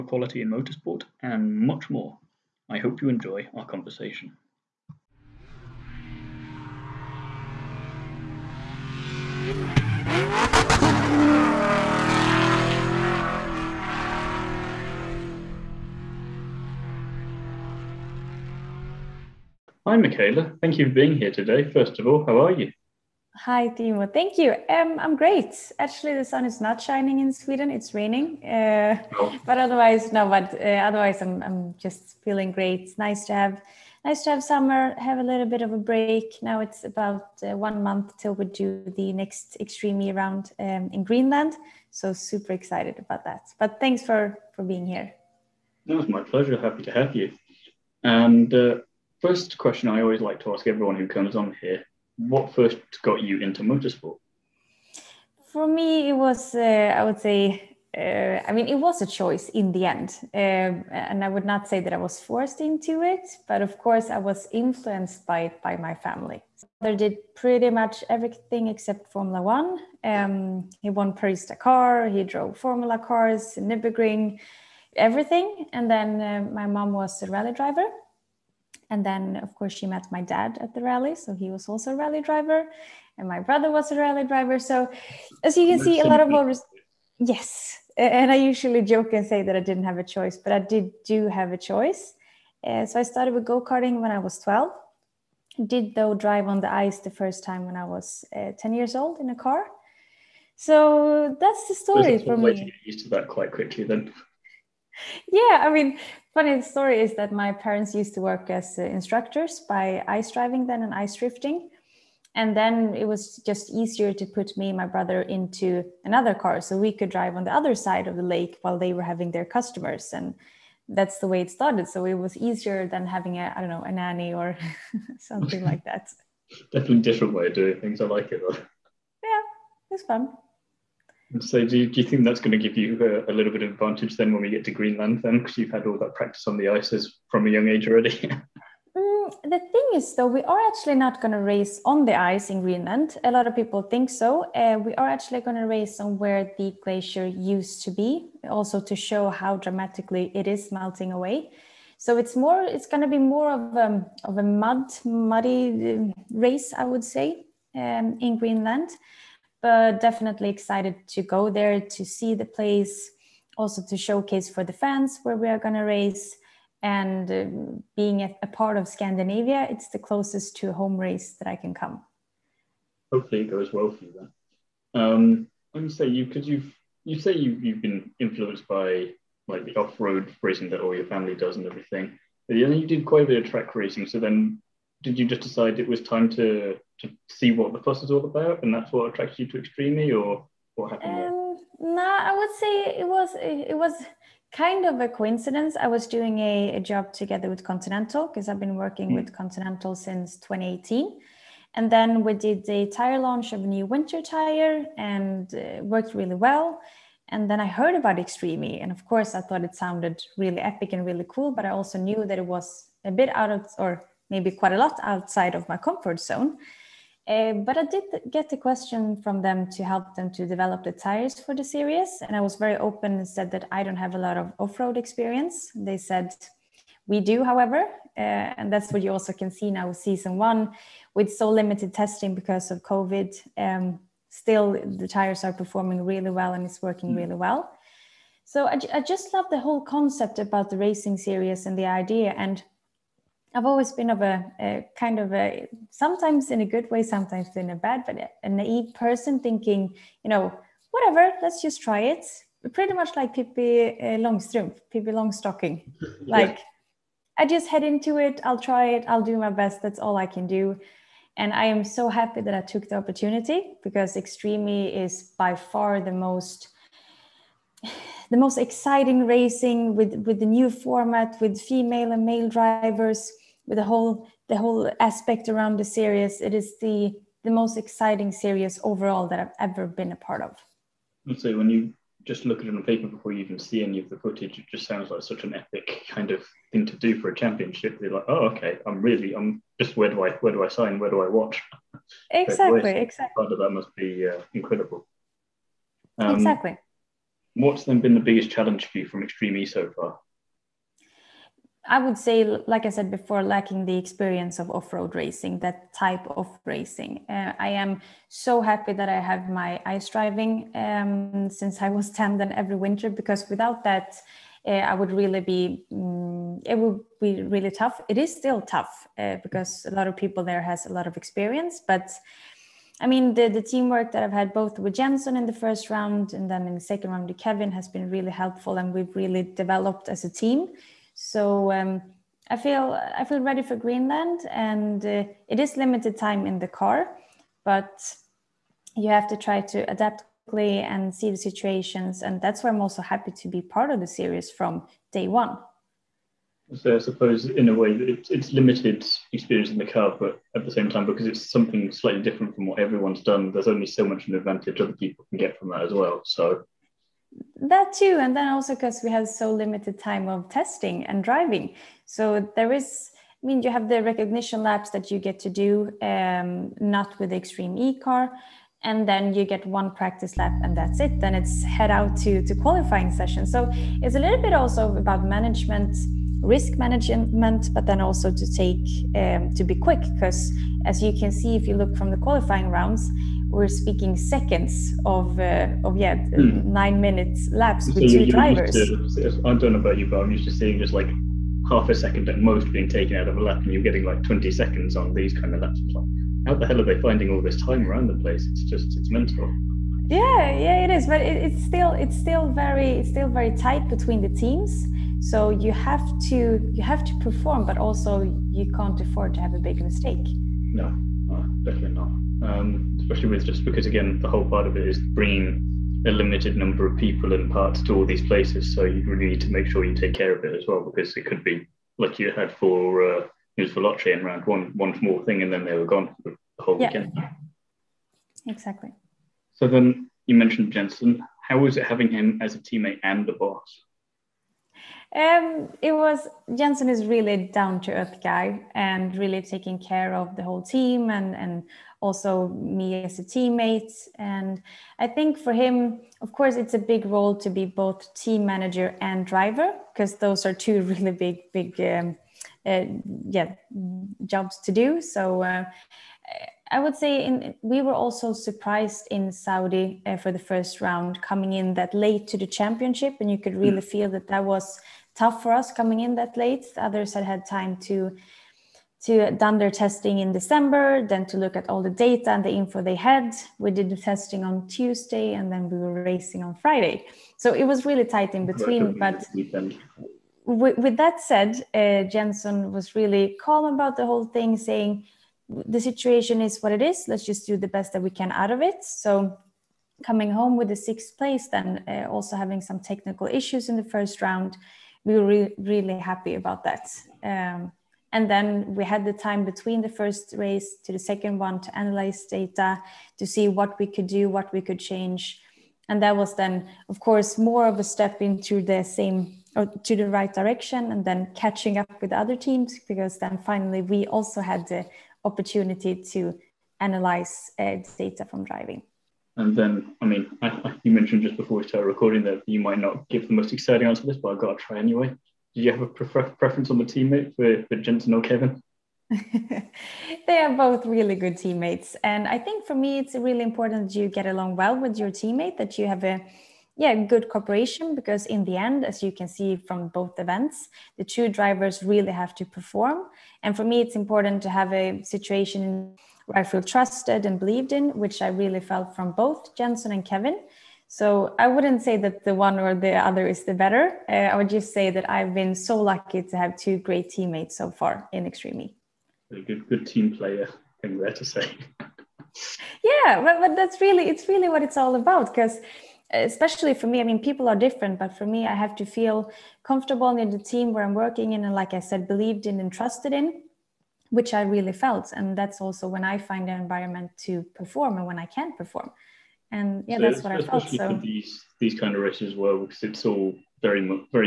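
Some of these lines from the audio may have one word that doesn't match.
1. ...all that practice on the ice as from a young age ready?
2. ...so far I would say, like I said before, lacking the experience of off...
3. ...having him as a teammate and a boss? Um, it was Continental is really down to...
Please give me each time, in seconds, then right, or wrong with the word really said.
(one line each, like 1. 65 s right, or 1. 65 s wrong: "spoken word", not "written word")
1. 135 s wrong: "already", not "ready"
2. 299 s right
3. 431 s wrong: "Jensen", not "Continental".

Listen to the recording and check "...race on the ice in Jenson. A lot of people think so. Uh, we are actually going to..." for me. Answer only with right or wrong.
wrong.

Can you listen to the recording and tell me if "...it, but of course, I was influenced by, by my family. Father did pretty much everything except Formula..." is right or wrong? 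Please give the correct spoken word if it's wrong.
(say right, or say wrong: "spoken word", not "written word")
right.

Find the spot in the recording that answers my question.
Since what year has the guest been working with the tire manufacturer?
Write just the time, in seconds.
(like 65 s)
200 s.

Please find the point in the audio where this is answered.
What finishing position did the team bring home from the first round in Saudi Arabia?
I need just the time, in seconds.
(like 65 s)
490 s.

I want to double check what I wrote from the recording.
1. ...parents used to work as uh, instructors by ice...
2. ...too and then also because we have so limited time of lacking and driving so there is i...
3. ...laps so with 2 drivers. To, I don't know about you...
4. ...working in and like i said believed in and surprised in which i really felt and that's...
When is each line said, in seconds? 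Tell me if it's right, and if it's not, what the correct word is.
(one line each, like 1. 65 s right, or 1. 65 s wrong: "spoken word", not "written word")
1. 107 s right
2. 357 s wrong: "testing", not "lacking"
3. 387 s right
4. 570 s wrong: "trusted", not "surprised".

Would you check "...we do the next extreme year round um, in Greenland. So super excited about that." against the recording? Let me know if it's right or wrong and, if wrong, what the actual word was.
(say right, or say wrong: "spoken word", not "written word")
right.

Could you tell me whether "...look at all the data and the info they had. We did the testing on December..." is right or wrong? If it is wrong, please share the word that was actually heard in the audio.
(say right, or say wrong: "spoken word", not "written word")
wrong: "Tuesday", not "December".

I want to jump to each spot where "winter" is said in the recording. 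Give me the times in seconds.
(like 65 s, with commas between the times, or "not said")
203 s, 312 s.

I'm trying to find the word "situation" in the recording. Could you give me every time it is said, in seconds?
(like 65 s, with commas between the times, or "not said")
341 s, 485 s, 545 s.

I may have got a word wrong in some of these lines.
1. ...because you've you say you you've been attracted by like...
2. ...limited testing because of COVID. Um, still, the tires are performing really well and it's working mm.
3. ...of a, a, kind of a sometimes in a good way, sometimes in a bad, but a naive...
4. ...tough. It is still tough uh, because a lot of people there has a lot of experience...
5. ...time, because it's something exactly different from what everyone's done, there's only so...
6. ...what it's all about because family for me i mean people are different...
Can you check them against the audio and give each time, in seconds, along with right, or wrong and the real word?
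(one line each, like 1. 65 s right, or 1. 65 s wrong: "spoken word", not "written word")
1. 176 s wrong: "influenced", not "attracted"
2. 231 s right
3. 244 s right
4. 317 s right
5. 350 s wrong: "slightly", not "exactly"
6. 564 s wrong: "especially", not "family".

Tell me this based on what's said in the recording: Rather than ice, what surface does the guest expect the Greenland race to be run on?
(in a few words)
mud.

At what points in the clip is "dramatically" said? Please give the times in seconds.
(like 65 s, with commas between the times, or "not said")
149 s.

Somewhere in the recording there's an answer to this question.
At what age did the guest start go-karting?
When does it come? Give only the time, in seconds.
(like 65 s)
94 s.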